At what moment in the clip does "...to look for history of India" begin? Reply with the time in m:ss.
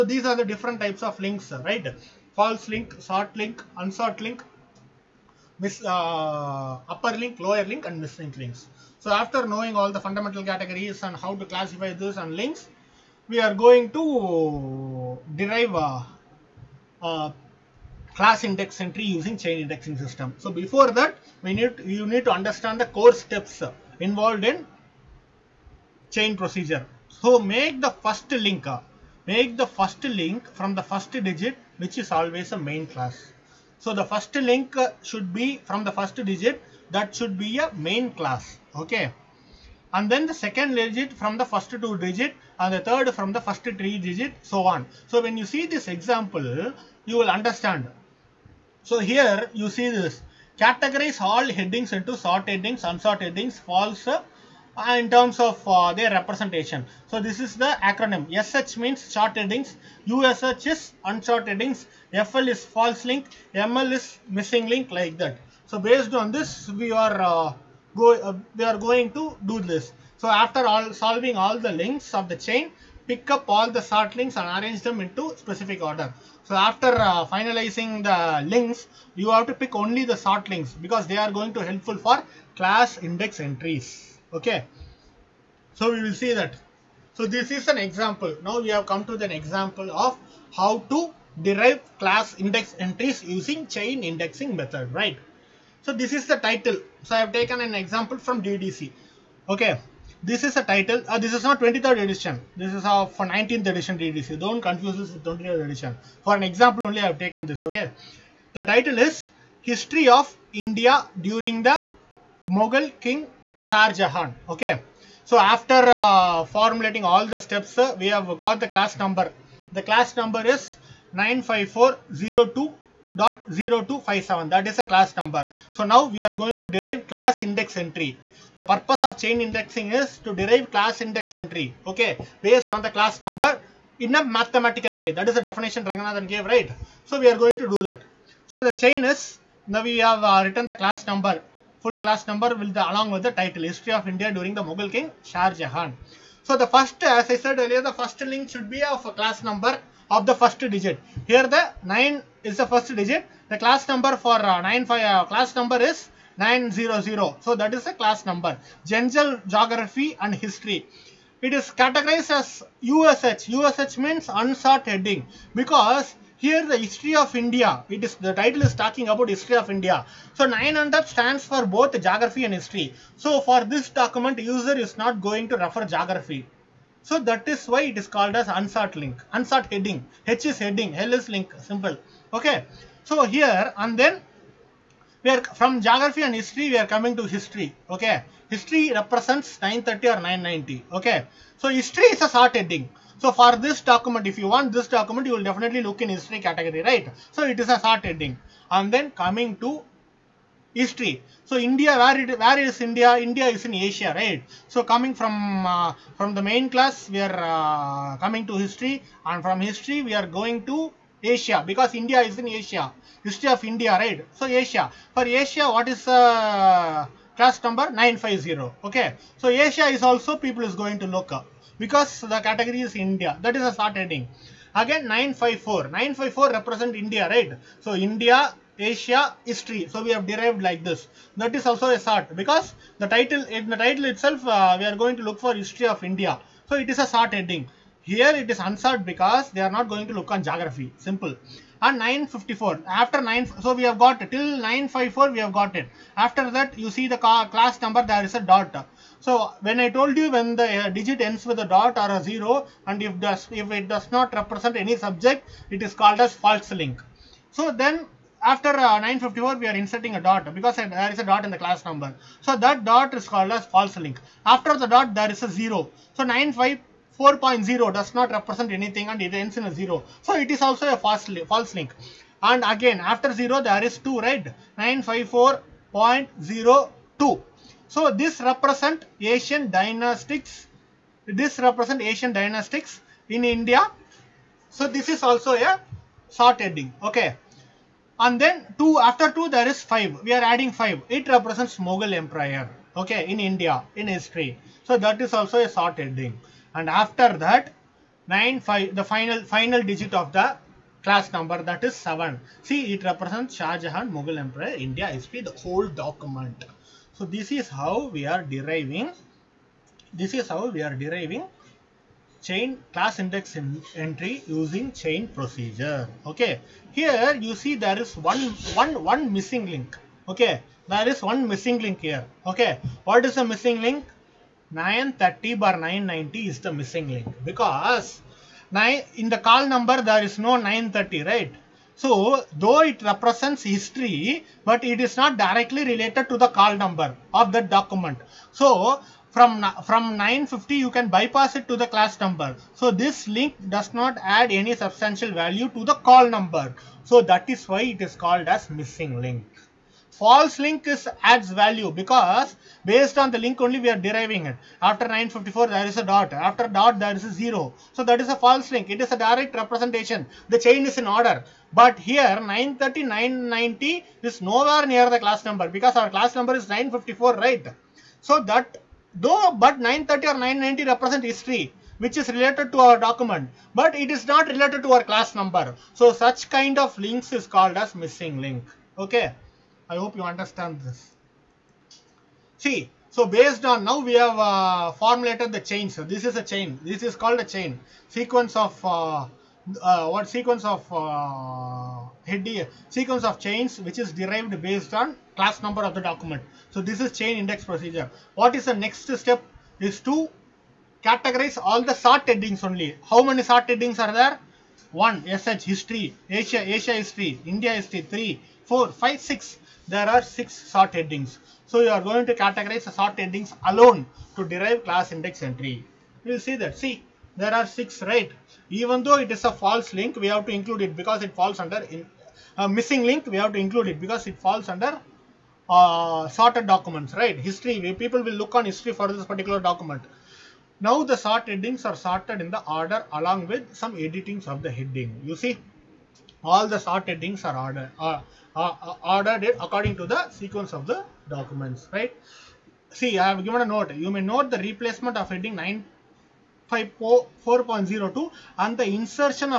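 3:55.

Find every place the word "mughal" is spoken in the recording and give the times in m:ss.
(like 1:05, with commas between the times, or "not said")
1:52, 2:24, 4:51, 5:04.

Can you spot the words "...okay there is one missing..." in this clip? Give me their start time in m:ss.
5:20.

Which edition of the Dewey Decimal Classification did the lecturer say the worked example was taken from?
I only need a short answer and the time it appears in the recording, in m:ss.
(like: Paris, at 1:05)
19th edition, at 1:43.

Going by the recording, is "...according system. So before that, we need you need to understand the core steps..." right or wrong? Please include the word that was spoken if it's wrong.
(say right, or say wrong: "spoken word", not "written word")
wrong: "indexing", not "according".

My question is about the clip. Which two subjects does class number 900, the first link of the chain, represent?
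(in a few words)
General geography and history.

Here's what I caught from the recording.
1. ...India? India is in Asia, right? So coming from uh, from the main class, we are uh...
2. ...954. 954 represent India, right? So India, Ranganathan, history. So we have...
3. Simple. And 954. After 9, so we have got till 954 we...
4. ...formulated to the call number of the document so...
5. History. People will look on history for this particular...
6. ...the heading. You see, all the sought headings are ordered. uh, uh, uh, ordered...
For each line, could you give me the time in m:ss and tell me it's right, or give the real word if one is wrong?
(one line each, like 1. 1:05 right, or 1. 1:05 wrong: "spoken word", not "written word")
1. 3:22 right
2. 3:45 wrong: "Asia", not "Ranganathan"
3. 4:00 right
4. 5:35 wrong: "related", not "formulated"
5. 7:07 right
6. 7:14 right.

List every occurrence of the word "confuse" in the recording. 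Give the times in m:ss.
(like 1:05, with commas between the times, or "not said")
1:44.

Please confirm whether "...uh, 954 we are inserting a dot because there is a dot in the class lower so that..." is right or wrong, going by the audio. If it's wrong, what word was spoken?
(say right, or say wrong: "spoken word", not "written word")
wrong: "number", not "lower".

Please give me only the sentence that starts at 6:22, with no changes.
See, so based on now we have uh, formulated the chain.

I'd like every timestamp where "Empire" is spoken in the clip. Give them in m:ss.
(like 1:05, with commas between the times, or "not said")
4:52, 5:04.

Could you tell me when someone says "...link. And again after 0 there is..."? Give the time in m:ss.
4:31.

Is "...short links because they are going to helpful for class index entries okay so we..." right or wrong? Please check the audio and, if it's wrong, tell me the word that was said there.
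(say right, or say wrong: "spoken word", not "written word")
right.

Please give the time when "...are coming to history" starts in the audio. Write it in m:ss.
3:06.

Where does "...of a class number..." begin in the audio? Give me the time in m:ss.
2:28.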